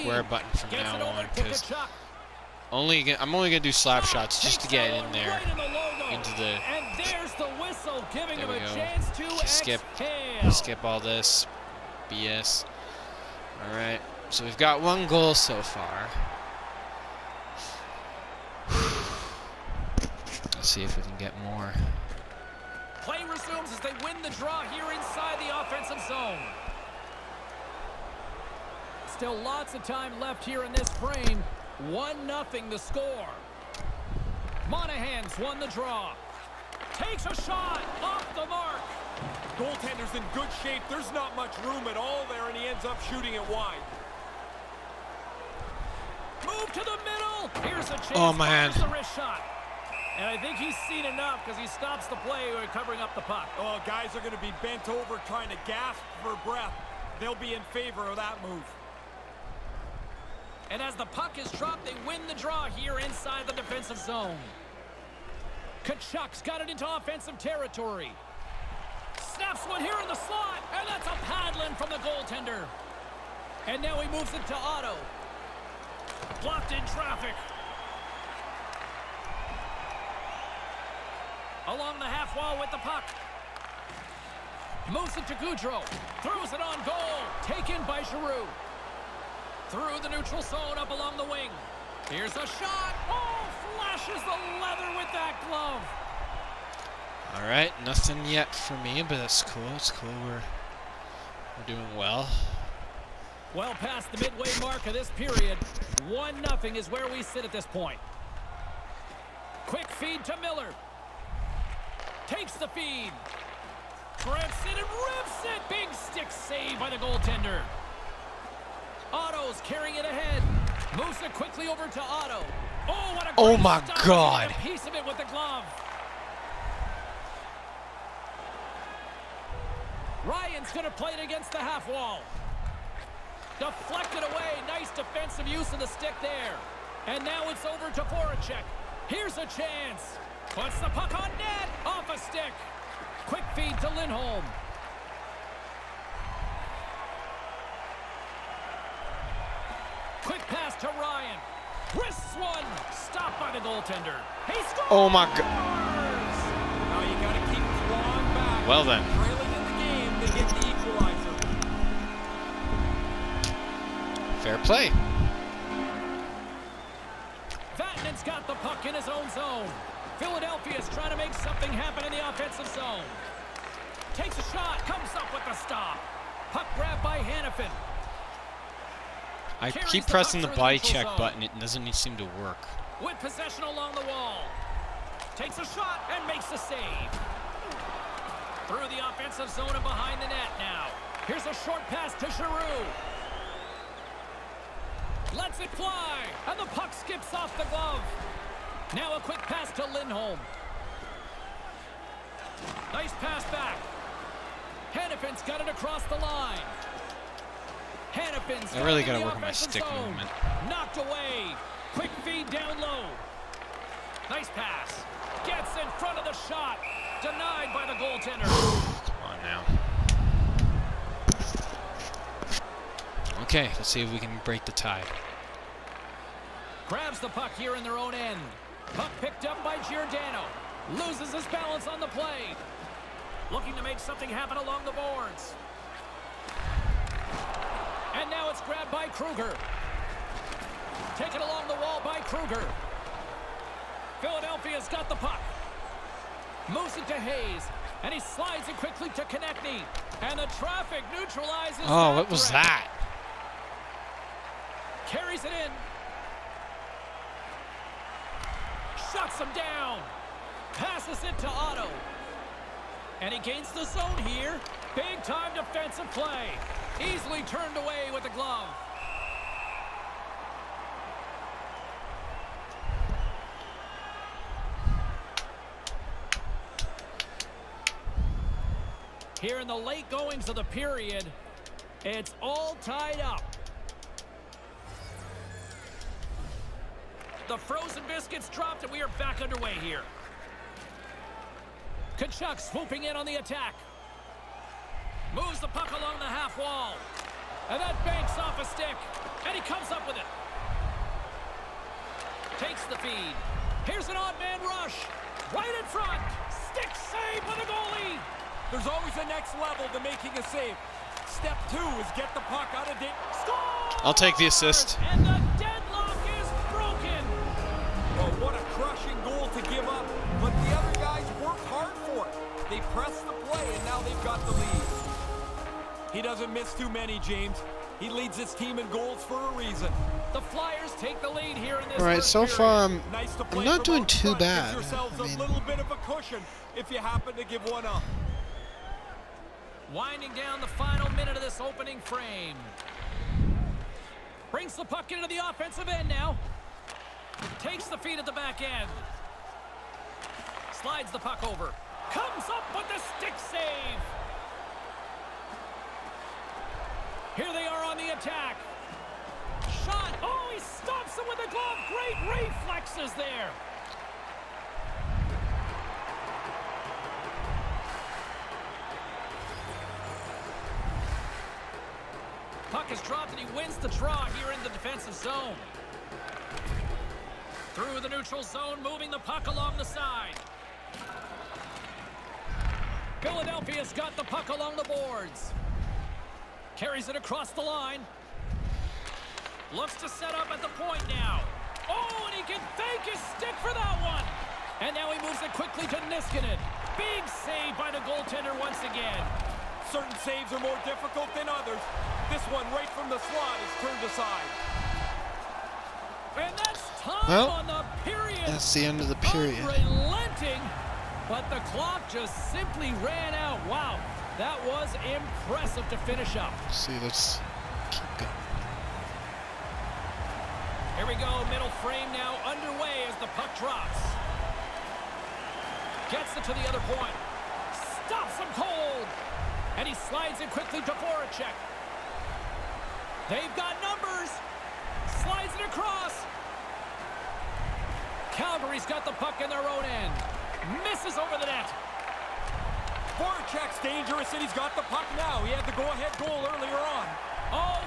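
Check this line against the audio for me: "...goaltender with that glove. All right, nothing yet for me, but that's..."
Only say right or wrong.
wrong.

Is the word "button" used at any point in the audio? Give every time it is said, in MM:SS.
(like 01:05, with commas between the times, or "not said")
00:00, 03:01.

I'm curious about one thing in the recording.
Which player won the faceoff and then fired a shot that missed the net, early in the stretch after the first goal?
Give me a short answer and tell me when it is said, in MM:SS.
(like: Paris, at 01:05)
Monahan, at 00:34.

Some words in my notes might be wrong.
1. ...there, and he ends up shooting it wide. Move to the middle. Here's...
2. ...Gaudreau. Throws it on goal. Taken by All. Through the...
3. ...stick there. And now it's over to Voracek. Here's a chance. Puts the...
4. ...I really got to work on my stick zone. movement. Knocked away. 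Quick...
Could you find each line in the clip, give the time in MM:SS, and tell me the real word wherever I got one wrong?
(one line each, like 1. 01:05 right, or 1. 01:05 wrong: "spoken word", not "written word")
1. 00:42 right
2. 01:25 wrong: "Giroux", not "All"
3. 02:15 right
4. 03:28 right.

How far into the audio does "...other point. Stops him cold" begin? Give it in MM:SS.
07:06.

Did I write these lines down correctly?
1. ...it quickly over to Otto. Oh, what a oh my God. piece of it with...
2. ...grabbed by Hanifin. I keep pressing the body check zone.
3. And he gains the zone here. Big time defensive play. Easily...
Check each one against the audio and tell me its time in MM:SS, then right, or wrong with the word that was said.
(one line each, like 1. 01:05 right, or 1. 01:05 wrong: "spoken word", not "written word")
1. 02:01 right
2. 02:56 right
3. 04:23 right.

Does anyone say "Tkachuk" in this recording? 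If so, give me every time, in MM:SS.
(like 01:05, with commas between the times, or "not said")
01:05, 04:52.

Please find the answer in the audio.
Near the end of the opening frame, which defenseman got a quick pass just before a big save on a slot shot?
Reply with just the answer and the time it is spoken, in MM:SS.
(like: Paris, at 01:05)
Niskanen, at 06:36.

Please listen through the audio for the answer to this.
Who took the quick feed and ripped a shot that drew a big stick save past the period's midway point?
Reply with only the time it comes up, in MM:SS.
01:50.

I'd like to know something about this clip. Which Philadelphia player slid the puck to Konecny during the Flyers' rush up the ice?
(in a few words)
Hayes.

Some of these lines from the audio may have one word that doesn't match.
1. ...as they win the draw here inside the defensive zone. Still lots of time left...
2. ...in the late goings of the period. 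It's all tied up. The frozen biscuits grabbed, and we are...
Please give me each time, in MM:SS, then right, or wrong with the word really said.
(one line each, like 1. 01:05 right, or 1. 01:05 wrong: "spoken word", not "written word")
1. 00:23 wrong: "offensive", not "defensive"
2. 04:39 wrong: "dropped", not "grabbed".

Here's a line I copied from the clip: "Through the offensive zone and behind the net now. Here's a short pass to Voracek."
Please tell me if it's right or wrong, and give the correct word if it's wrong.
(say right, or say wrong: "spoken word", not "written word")
wrong: "Giroux", not "Voracek".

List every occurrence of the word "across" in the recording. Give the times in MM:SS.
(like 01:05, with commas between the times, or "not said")
03:25, 06:27, 07:15.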